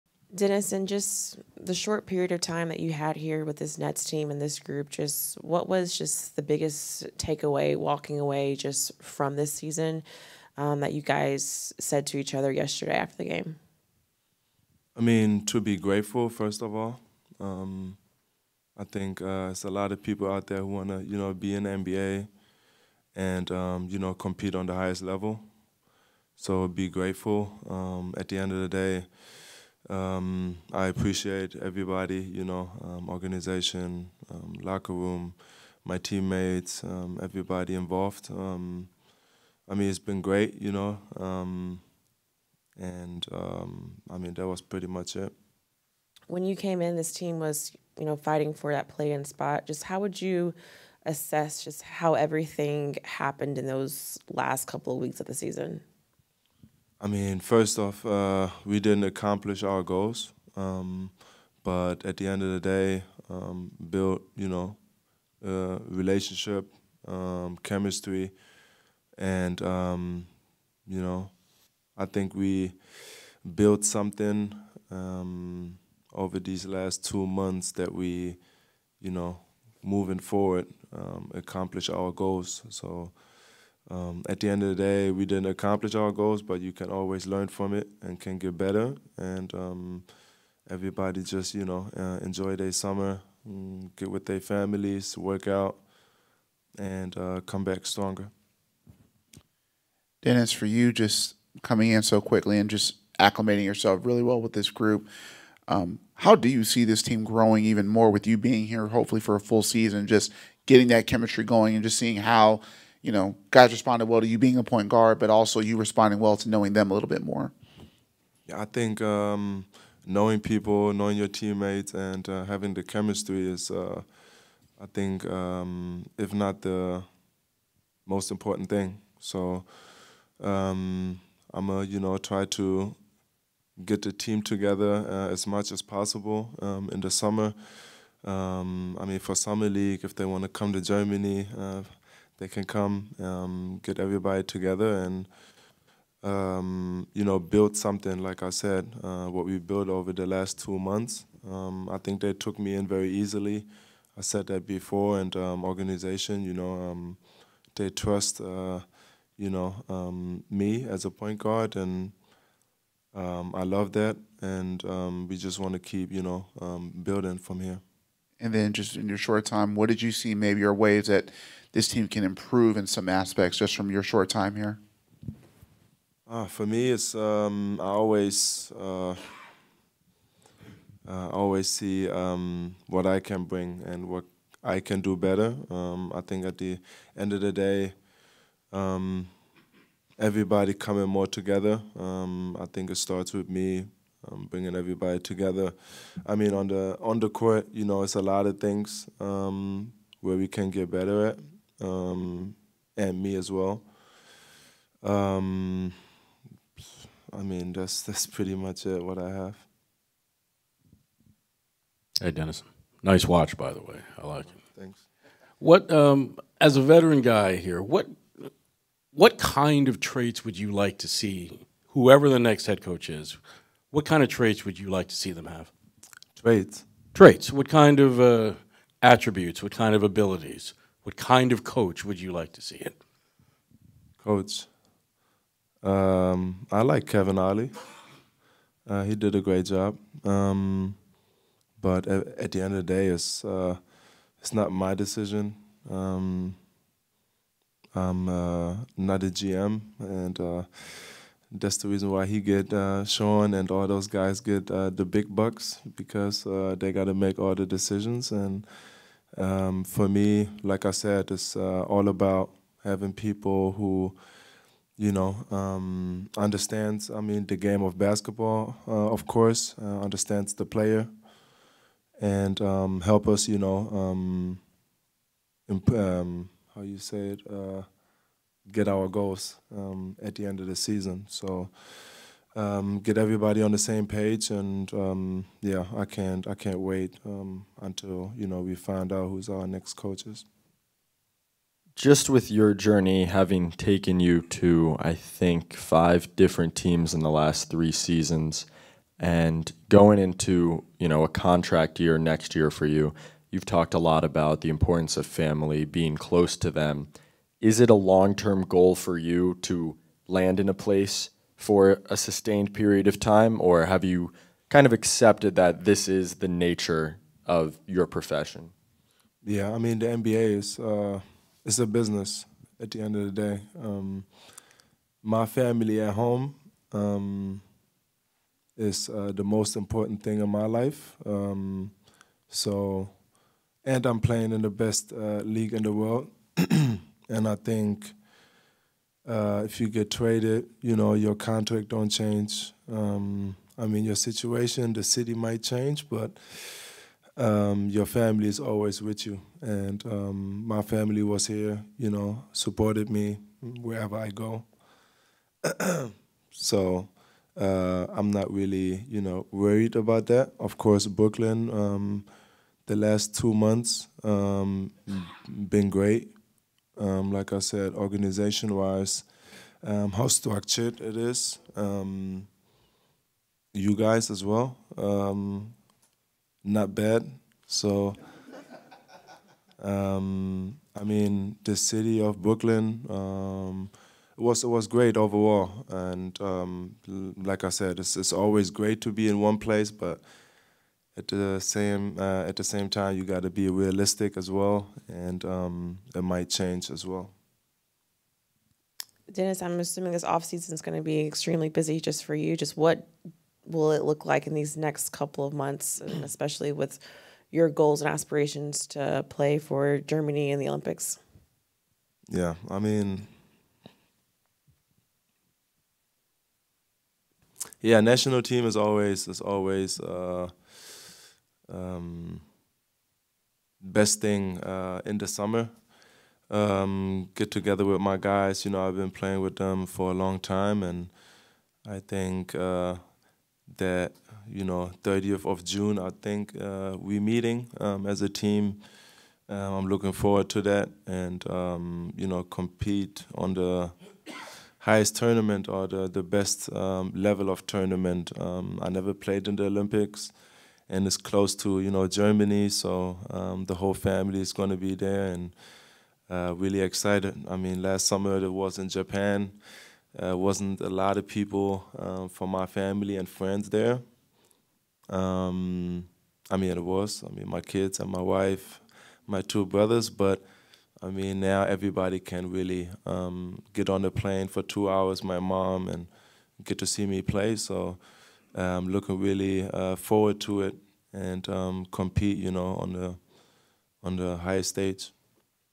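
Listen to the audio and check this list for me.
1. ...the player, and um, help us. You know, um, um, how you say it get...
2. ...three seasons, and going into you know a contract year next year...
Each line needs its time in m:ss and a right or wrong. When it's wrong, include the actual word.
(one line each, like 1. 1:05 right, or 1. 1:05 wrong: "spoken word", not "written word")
1. 4:30 right
2. 4:57 right.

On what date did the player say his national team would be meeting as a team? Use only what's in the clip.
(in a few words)
30 June.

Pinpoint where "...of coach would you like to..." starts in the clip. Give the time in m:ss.
3:51.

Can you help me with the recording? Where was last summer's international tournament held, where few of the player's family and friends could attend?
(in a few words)
Japan.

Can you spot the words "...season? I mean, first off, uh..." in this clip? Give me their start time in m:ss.
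0:55.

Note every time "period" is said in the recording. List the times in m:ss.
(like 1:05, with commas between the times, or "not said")
0:02, 5:12.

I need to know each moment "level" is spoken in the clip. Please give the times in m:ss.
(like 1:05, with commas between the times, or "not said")
0:25, 7:27.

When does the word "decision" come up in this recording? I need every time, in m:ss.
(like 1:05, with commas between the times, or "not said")
4:04, 4:17.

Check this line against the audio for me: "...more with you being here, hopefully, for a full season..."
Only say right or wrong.
right.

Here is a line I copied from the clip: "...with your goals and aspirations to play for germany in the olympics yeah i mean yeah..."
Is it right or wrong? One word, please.
right.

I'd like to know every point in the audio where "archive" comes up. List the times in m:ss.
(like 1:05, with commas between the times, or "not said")
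not said.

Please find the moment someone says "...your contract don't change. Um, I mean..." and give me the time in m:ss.
5:41.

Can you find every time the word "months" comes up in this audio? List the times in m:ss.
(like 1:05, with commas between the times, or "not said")
1:17, 2:30, 6:03, 6:45.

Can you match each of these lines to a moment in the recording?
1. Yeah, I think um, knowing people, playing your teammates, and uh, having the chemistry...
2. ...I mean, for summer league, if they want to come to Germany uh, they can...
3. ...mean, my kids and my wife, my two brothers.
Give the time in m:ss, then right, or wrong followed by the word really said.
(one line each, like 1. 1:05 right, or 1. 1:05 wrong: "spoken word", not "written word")
1. 1:58 wrong: "knowing", not "playing"
2. 2:19 right
3. 7:47 right.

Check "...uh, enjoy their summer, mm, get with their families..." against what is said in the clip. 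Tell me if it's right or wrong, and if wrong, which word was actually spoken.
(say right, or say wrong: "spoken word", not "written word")
right.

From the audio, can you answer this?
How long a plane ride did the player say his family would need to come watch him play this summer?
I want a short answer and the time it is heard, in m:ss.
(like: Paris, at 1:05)
2 hours, at 7:54.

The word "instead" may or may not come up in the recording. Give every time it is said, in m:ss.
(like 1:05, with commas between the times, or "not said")
not said.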